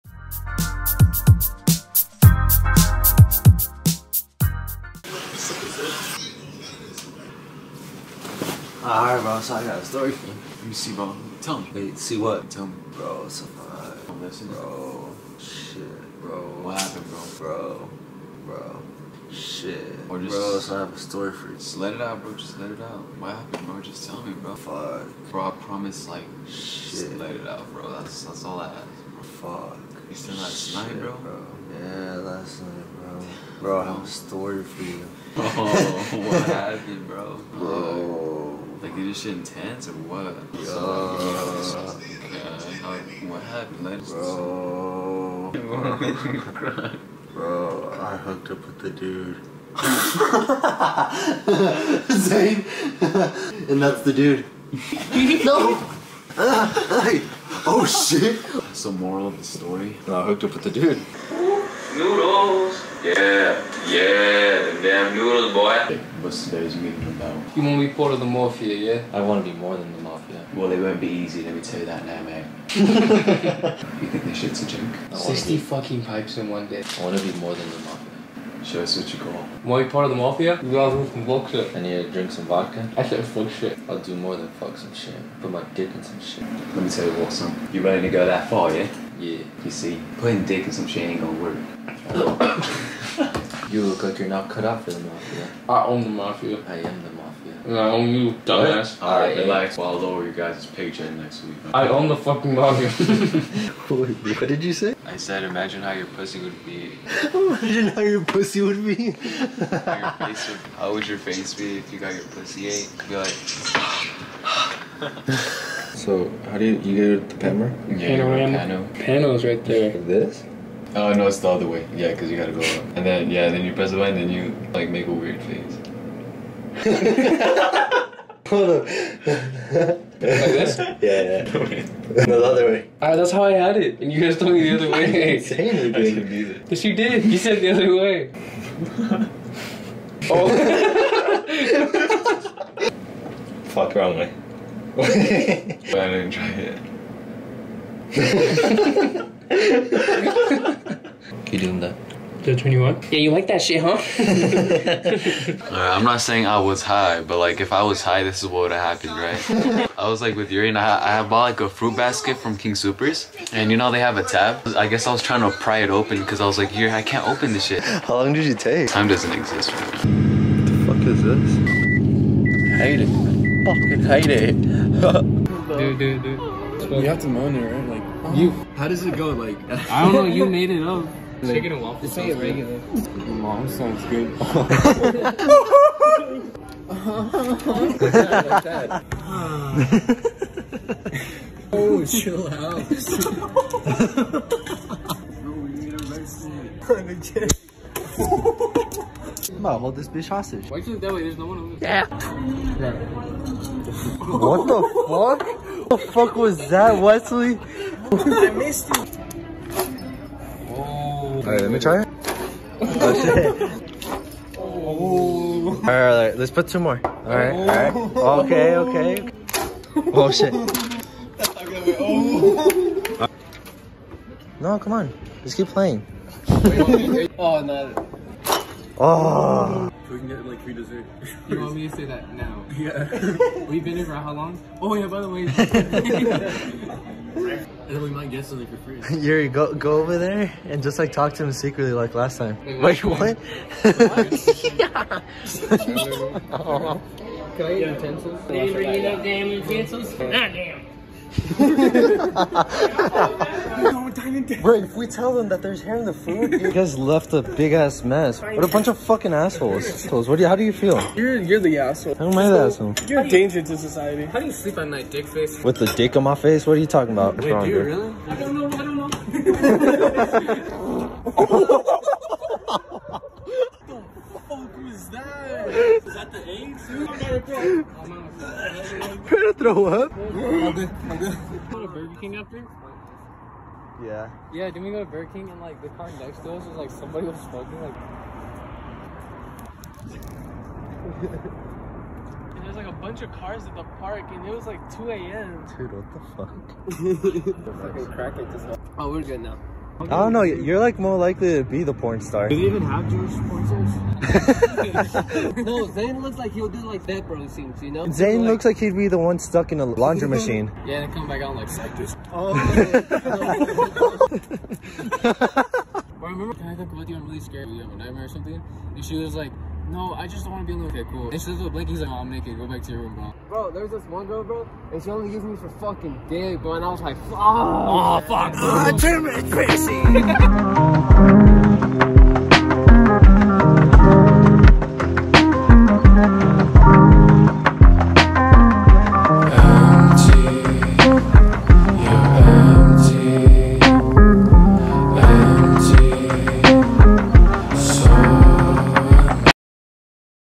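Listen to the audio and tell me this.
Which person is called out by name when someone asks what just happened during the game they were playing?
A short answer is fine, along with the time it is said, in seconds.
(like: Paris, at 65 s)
Wesley, at 207 s.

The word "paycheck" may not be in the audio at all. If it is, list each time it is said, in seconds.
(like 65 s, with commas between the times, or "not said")
100 s.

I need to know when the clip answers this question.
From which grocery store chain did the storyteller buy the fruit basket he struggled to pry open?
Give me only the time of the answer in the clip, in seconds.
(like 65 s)
162 s.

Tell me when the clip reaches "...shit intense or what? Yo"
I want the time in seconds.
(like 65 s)
39 s.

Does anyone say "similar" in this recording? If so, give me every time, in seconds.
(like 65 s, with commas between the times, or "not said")
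not said.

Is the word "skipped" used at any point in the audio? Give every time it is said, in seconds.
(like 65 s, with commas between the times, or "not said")
not said.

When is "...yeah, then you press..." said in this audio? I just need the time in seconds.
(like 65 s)
123 s.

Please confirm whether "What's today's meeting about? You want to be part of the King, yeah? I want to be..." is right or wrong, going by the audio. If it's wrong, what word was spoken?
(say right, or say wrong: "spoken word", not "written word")
wrong: "Mafia", not "King".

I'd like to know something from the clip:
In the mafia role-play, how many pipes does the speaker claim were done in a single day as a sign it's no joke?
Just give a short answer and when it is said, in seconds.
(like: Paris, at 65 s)
60, at 75 s.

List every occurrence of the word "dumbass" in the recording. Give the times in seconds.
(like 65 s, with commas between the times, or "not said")
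98 s.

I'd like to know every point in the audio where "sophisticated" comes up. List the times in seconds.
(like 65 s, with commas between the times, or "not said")
not said.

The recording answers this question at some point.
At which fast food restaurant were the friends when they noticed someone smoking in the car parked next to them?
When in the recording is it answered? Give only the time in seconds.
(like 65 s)
285 s.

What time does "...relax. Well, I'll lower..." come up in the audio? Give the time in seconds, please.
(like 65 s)
99 s.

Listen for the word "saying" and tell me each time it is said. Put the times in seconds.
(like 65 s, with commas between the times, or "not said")
156 s.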